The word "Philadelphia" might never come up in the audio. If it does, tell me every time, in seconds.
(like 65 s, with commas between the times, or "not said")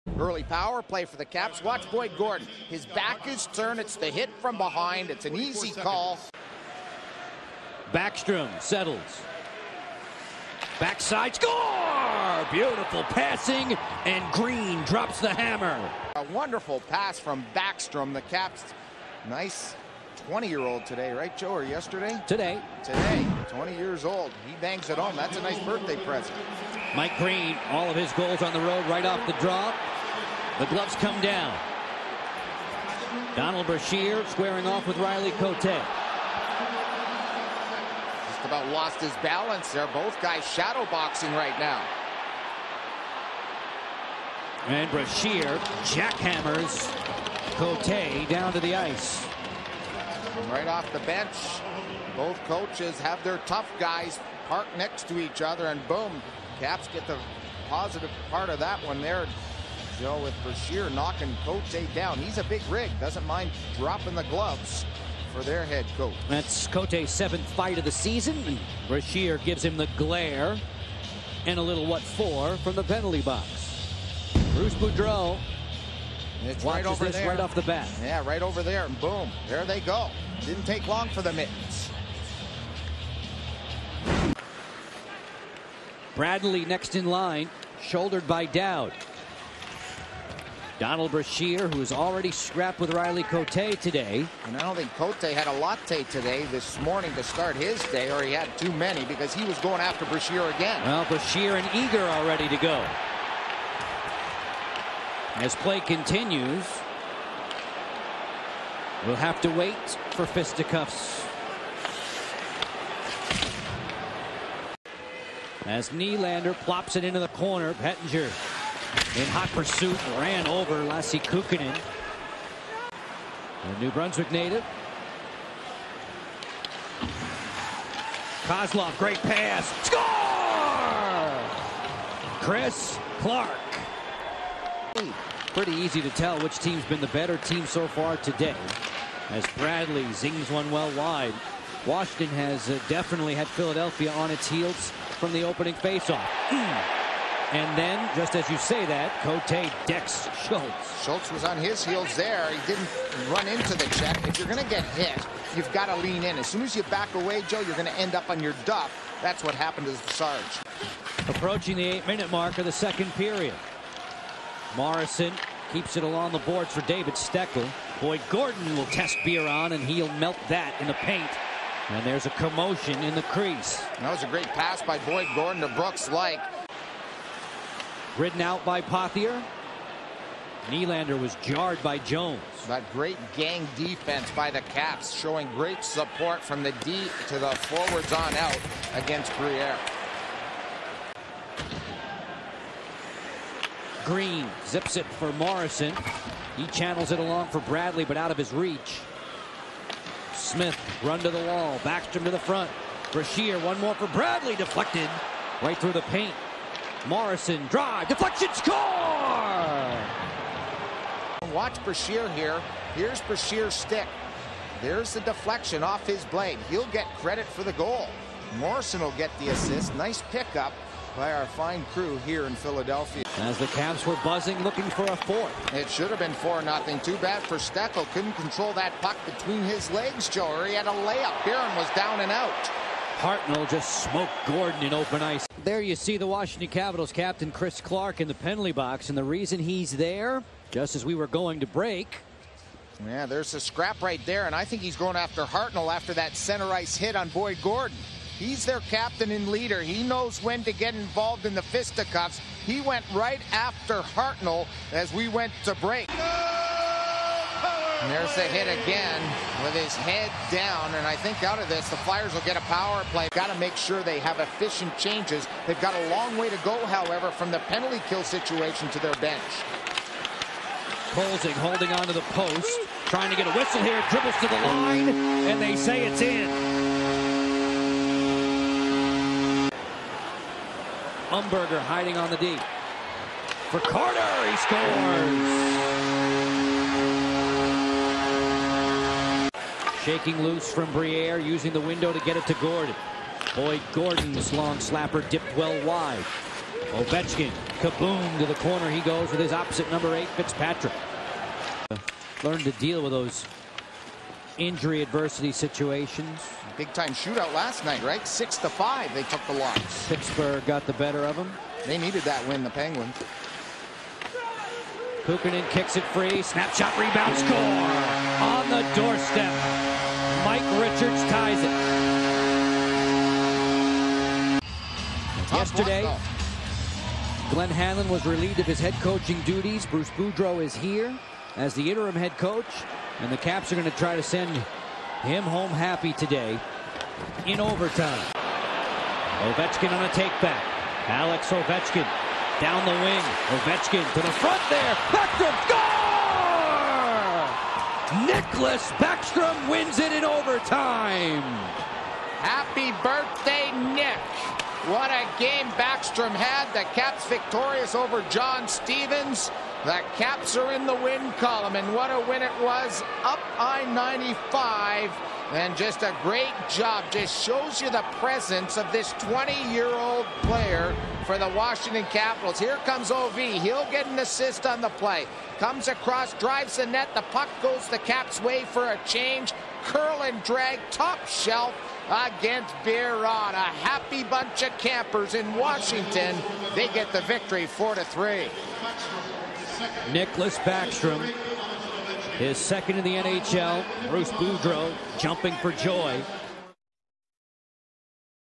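143 s, 222 s.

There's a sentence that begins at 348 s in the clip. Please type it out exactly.
Nicklas Backstrom wins it in overtime.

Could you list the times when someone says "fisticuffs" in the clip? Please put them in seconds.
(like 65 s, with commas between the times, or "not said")
110 s, 251 s.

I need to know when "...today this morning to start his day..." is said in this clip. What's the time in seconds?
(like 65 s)
96 s.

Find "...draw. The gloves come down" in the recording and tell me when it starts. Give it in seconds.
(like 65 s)
29 s.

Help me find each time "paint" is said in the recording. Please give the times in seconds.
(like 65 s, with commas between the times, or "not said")
170 s, 206 s.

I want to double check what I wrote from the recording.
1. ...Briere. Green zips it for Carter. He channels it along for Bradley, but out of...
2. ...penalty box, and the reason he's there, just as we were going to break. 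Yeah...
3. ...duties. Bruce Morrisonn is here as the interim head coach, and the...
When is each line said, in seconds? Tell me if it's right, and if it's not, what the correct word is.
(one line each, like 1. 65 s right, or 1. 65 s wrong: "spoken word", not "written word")
1. 189 s wrong: "Morrisonn", not "Carter"
2. 238 s right
3. 329 s wrong: "Boudreau", not "Morrisonn".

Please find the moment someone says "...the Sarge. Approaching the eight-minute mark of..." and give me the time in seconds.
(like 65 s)
159 s.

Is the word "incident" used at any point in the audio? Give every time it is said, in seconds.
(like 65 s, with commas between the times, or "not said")
not said.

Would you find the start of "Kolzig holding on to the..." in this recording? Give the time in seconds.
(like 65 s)
271 s.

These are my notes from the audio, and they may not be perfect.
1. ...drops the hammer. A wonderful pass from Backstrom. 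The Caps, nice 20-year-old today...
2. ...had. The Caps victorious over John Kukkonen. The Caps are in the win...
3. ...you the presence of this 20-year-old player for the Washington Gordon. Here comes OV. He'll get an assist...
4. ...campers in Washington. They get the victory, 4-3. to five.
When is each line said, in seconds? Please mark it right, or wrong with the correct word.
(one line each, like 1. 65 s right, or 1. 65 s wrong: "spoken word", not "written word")
1. 14 s right
2. 356 s wrong: "Stevens", not "Kukkonen"
3. 367 s wrong: "Capitals", not "Gordon"
4. 384 s wrong: "three", not "five".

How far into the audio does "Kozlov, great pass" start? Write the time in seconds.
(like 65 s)
128 s.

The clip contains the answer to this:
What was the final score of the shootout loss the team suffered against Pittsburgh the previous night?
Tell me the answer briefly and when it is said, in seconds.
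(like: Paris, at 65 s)
6 to 5, at 308 s.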